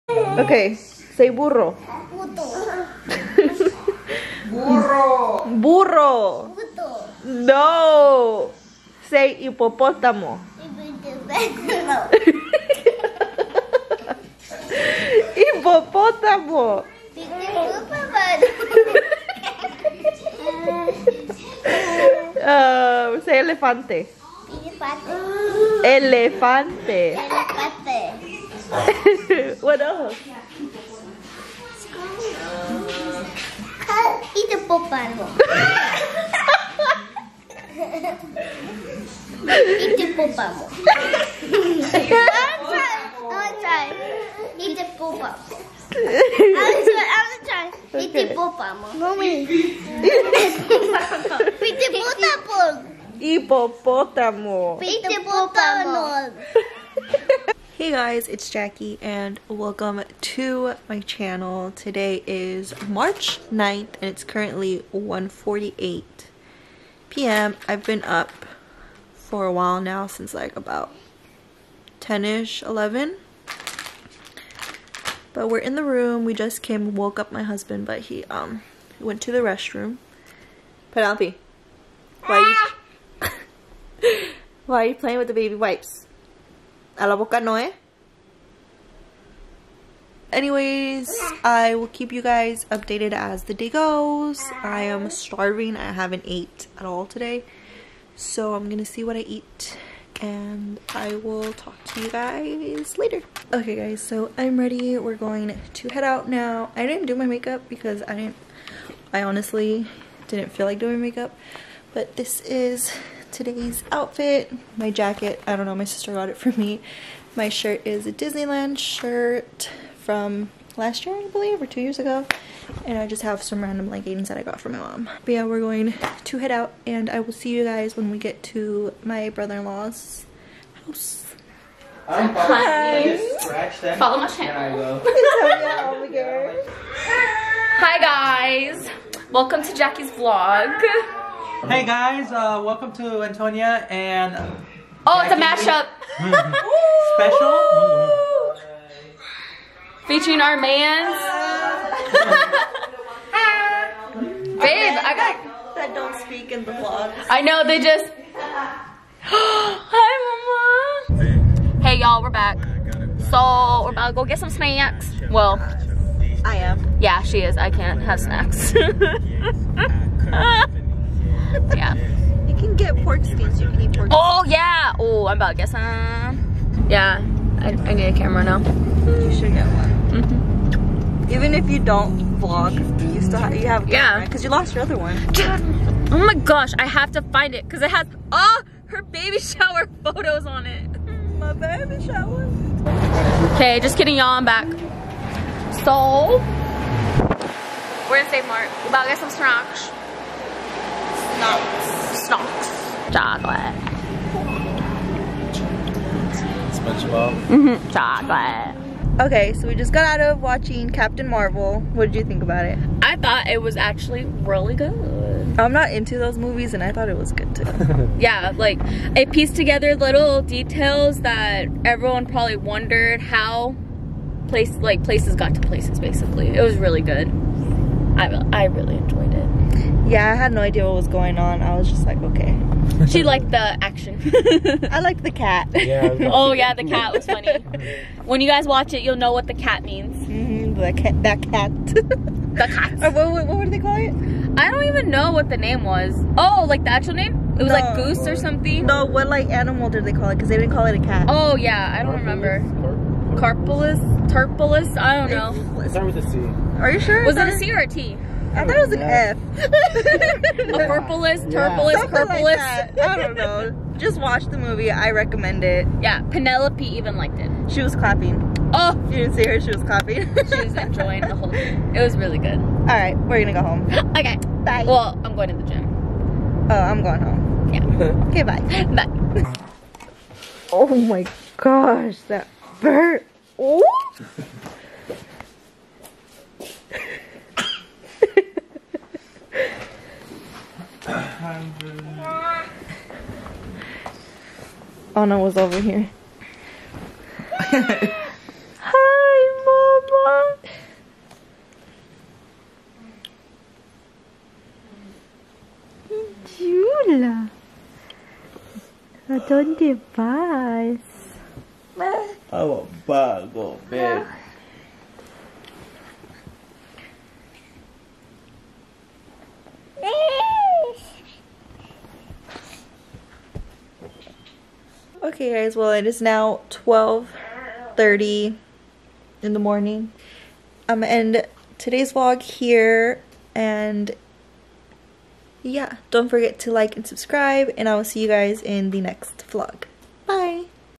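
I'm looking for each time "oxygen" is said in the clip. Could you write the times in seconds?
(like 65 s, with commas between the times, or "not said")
not said.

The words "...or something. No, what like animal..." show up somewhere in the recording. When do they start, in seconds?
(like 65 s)
248 s.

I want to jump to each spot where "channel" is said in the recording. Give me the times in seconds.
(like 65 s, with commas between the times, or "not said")
60 s, 134 s.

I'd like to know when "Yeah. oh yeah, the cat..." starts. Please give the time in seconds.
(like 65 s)
235 s.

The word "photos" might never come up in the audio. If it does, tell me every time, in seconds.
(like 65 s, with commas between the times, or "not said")
190 s.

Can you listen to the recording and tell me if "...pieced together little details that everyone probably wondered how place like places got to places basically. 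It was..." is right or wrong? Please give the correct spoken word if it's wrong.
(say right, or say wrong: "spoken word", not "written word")
right.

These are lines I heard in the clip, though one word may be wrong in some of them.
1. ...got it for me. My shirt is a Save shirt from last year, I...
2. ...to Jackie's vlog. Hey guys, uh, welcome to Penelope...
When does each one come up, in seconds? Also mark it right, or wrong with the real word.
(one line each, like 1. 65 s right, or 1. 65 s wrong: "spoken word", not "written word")
1. 116 s wrong: "Disneyland", not "Save"
2. 139 s wrong: "Antonia", not "Penelope".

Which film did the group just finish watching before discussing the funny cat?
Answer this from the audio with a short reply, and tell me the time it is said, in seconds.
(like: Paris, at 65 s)
Captain Marvel, at 210 s.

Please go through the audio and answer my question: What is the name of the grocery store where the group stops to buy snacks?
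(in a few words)
Save Mart.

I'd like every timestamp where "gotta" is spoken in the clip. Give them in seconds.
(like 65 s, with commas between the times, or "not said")
not said.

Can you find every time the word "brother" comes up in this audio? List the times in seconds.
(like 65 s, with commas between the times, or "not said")
129 s.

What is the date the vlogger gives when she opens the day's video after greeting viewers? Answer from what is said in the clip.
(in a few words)
March 9th.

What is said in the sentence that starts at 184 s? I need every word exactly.
Because you lost your other one.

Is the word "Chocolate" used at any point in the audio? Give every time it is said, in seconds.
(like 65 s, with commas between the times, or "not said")
203 s, 207 s.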